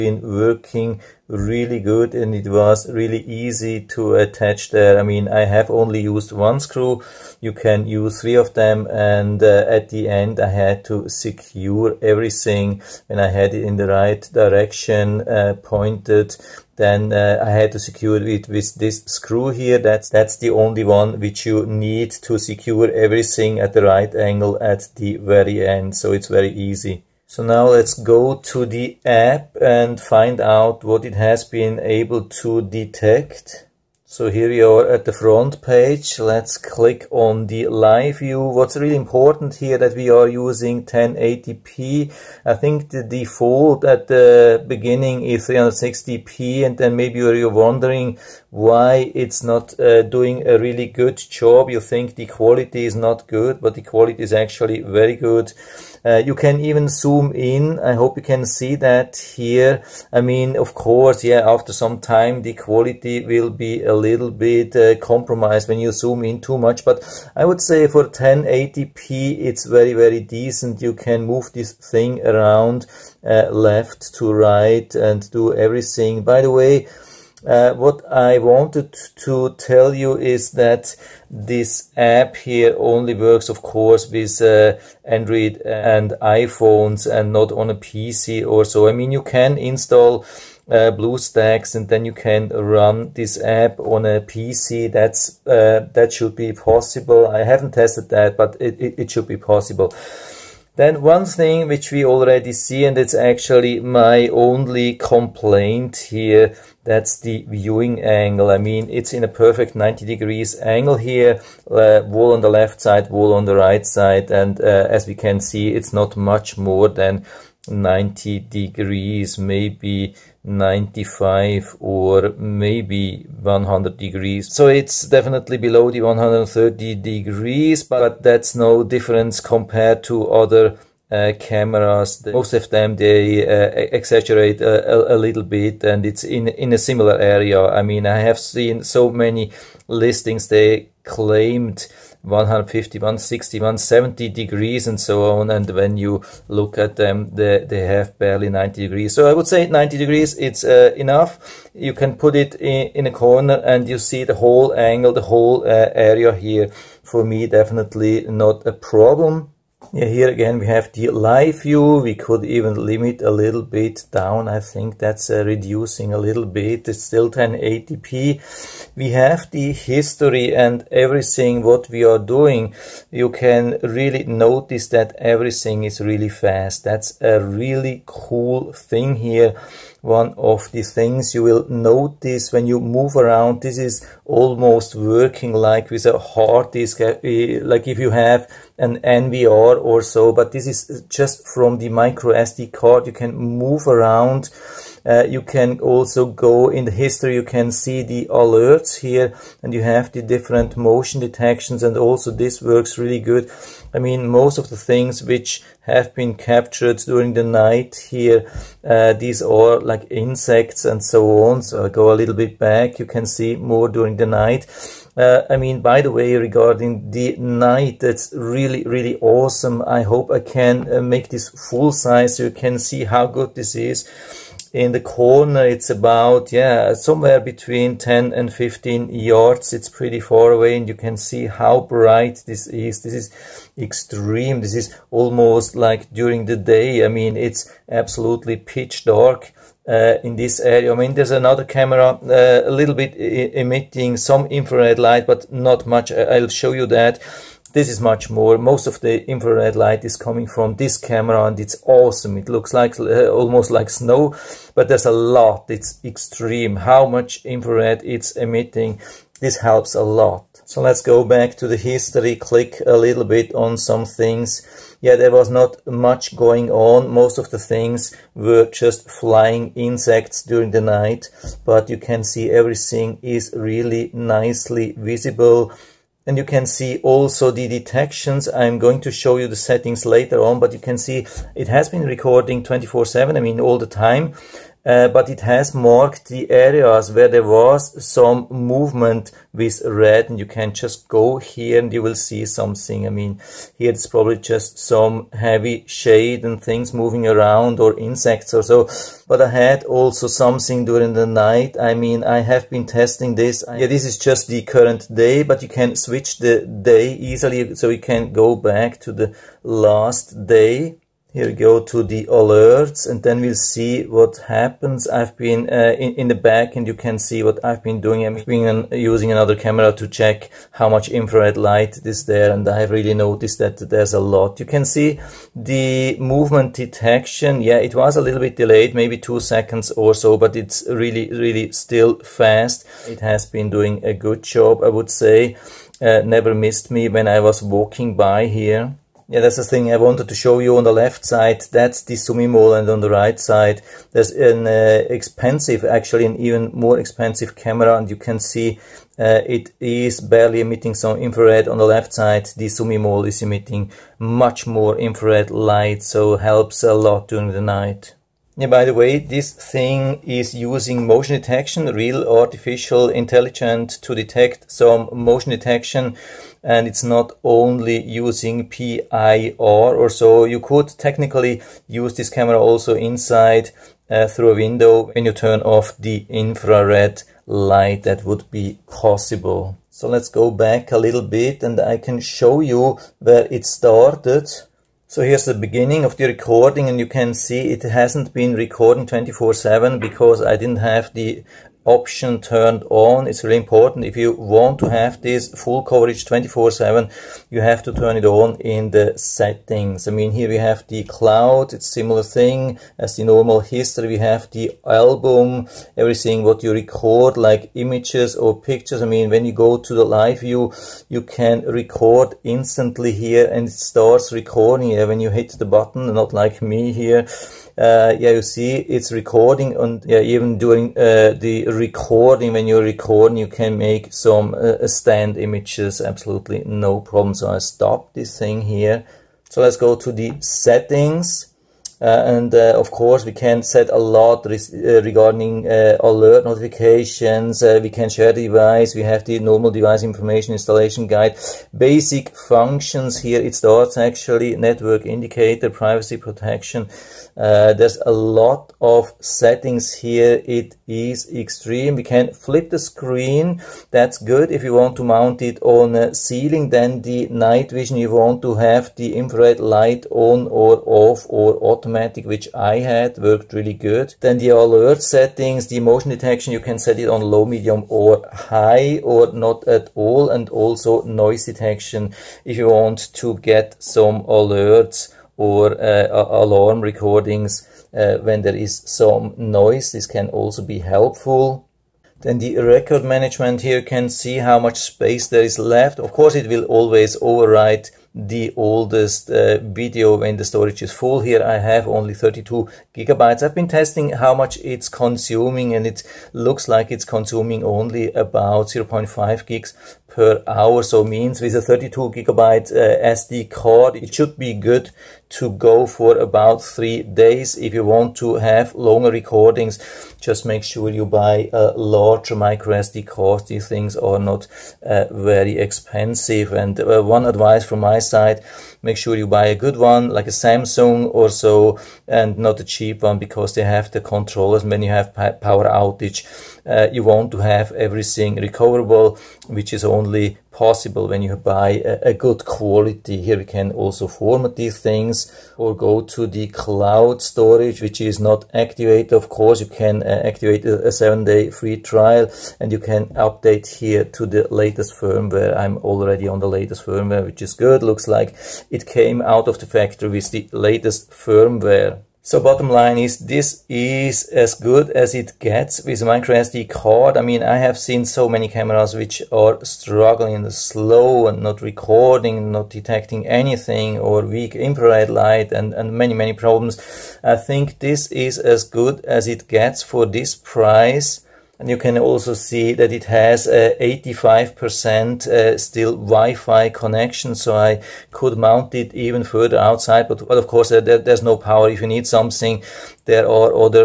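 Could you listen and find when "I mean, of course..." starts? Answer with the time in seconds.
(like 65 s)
60 s.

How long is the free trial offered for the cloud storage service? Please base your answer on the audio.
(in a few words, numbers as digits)
7 days.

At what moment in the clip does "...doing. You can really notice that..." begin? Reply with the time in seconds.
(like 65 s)
172 s.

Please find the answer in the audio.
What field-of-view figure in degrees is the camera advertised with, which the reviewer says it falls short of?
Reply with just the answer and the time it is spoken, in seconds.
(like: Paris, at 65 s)
130 degrees, at 126 s.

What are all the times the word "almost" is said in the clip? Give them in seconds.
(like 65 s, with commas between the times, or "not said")
184 s, 235 s, 253 s.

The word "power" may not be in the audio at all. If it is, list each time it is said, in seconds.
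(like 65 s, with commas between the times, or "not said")
525 s, 581 s.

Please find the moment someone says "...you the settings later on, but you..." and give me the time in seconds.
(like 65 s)
279 s.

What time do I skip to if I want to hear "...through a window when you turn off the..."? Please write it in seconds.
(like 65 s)
374 s.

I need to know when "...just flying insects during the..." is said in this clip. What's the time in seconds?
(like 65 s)
268 s.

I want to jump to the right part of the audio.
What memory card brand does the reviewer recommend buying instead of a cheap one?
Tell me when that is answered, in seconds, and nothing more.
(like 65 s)
520 s.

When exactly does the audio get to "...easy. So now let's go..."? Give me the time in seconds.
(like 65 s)
26 s.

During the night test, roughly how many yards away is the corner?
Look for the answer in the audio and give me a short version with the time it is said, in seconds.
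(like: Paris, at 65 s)
10 to 15 yards, at 227 s.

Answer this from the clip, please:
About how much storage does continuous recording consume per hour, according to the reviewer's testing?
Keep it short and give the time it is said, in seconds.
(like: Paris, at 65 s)
0.5 GB, at 498 s.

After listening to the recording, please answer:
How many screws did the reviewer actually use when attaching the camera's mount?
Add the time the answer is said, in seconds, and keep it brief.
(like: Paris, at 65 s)
1, at 6 s.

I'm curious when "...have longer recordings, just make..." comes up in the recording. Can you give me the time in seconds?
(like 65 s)
508 s.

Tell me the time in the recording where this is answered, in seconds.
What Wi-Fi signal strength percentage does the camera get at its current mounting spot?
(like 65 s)
573 s.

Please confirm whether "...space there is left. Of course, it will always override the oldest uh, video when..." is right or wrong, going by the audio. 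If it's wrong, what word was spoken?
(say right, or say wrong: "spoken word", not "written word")
right.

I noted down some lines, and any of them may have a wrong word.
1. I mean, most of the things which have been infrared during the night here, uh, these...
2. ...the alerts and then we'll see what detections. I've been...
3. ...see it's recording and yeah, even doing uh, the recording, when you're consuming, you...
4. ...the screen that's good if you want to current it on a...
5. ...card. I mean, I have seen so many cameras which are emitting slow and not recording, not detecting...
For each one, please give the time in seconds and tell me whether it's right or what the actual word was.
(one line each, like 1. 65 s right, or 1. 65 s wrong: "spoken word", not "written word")
1. 203 s wrong: "captured", not "infrared"
2. 312 s wrong: "happens", not "detections"
3. 418 s wrong: "recording", not "consuming"
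4. 452 s wrong: "mount", not "current"
5. 556 s wrong: "struggling", not "emitting".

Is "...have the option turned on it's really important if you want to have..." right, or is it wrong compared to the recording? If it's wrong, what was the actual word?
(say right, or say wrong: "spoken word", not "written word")
right.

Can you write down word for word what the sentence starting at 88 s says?
I mean, you can install uh, BlueStacks and then you can run this app on a PC.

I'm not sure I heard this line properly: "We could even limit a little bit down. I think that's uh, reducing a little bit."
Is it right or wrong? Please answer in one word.
right.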